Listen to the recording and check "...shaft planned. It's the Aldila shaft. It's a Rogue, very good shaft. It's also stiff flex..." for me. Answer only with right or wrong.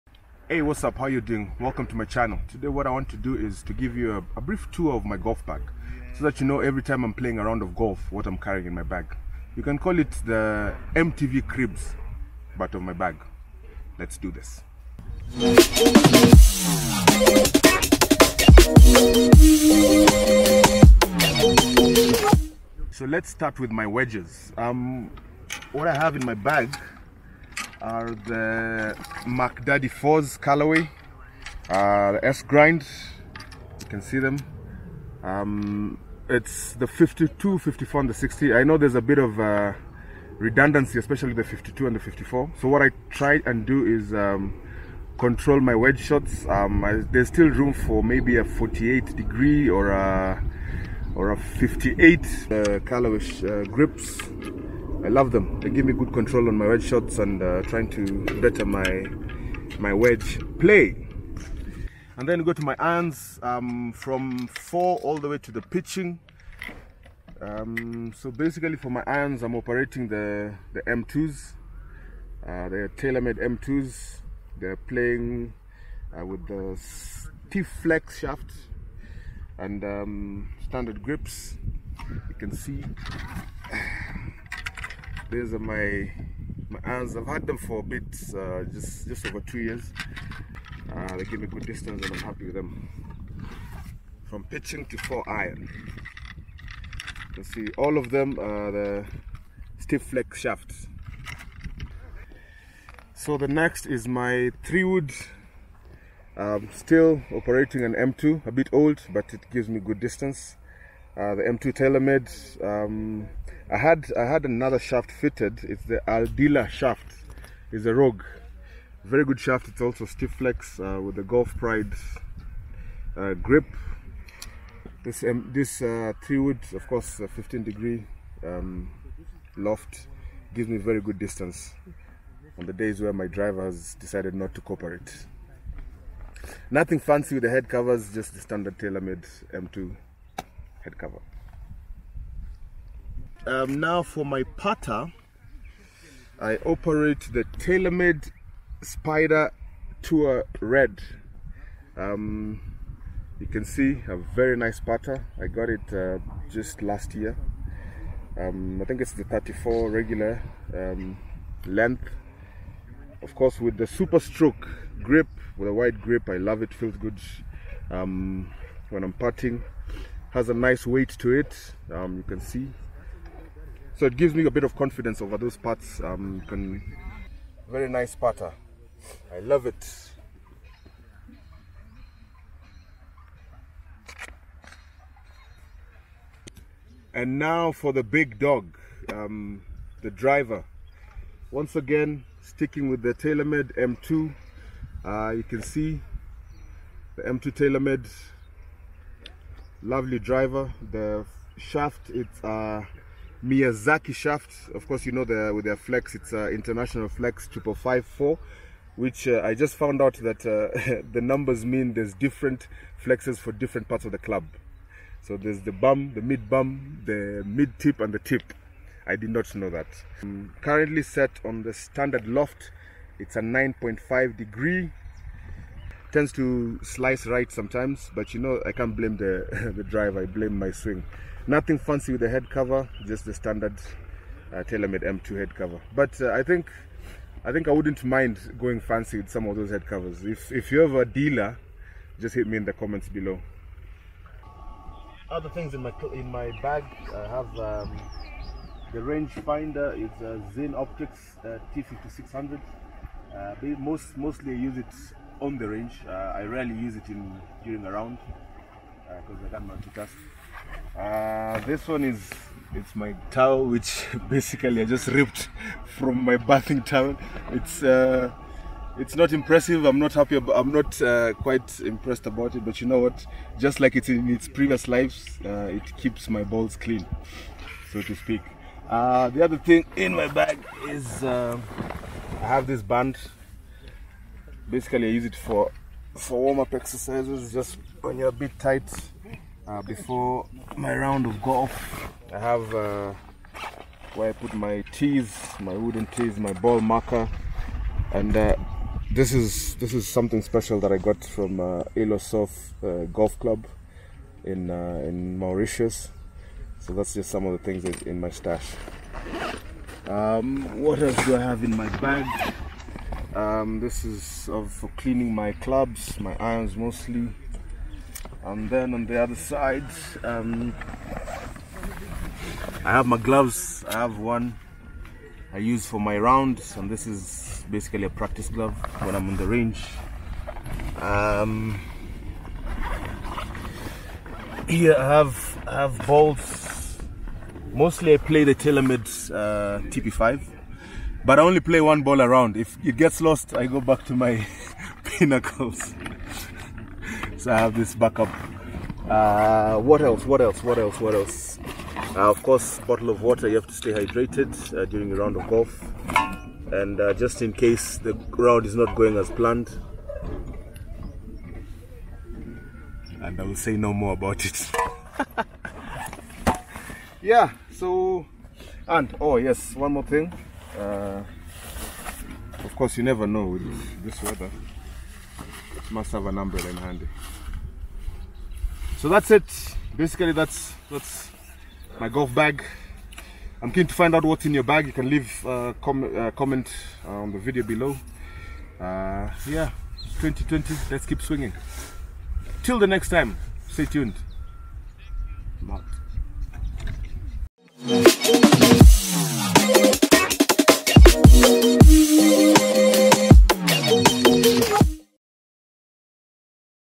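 wrong.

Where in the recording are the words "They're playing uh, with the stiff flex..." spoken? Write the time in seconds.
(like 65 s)
74 s.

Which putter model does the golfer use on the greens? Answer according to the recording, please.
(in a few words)
Spider Tour Red.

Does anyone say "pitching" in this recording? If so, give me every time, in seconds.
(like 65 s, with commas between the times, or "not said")
65 s, 94 s.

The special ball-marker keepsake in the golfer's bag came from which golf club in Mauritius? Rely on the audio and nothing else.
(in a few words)
Île aux Cerfs.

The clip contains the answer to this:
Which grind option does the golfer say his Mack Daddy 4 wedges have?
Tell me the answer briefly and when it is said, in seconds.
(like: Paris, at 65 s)
S grind, at 32 s.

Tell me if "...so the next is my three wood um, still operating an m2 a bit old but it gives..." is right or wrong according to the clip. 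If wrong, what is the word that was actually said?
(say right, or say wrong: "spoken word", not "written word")
right.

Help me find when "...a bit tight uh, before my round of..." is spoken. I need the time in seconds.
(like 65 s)
288 s.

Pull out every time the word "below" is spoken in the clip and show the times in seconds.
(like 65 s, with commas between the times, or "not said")
243 s, 387 s.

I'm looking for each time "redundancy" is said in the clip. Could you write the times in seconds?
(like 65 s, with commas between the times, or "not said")
40 s.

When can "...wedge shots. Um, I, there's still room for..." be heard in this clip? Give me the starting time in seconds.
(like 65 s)
45 s.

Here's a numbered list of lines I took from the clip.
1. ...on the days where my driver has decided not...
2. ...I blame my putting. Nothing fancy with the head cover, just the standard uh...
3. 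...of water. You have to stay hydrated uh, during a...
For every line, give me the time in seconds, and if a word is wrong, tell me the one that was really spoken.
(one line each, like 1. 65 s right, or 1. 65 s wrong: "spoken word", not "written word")
1. 132 s right
2. 230 s wrong: "swing", not "putting"
3. 353 s right.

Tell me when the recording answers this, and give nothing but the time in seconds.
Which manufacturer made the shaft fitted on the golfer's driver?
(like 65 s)
203 s.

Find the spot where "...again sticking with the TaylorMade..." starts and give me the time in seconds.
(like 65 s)
191 s.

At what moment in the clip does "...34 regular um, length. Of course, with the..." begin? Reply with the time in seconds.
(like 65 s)
159 s.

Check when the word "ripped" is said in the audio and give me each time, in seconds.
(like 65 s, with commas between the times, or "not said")
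265 s.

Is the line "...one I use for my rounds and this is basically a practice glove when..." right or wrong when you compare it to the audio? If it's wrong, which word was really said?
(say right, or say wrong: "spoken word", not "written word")
right.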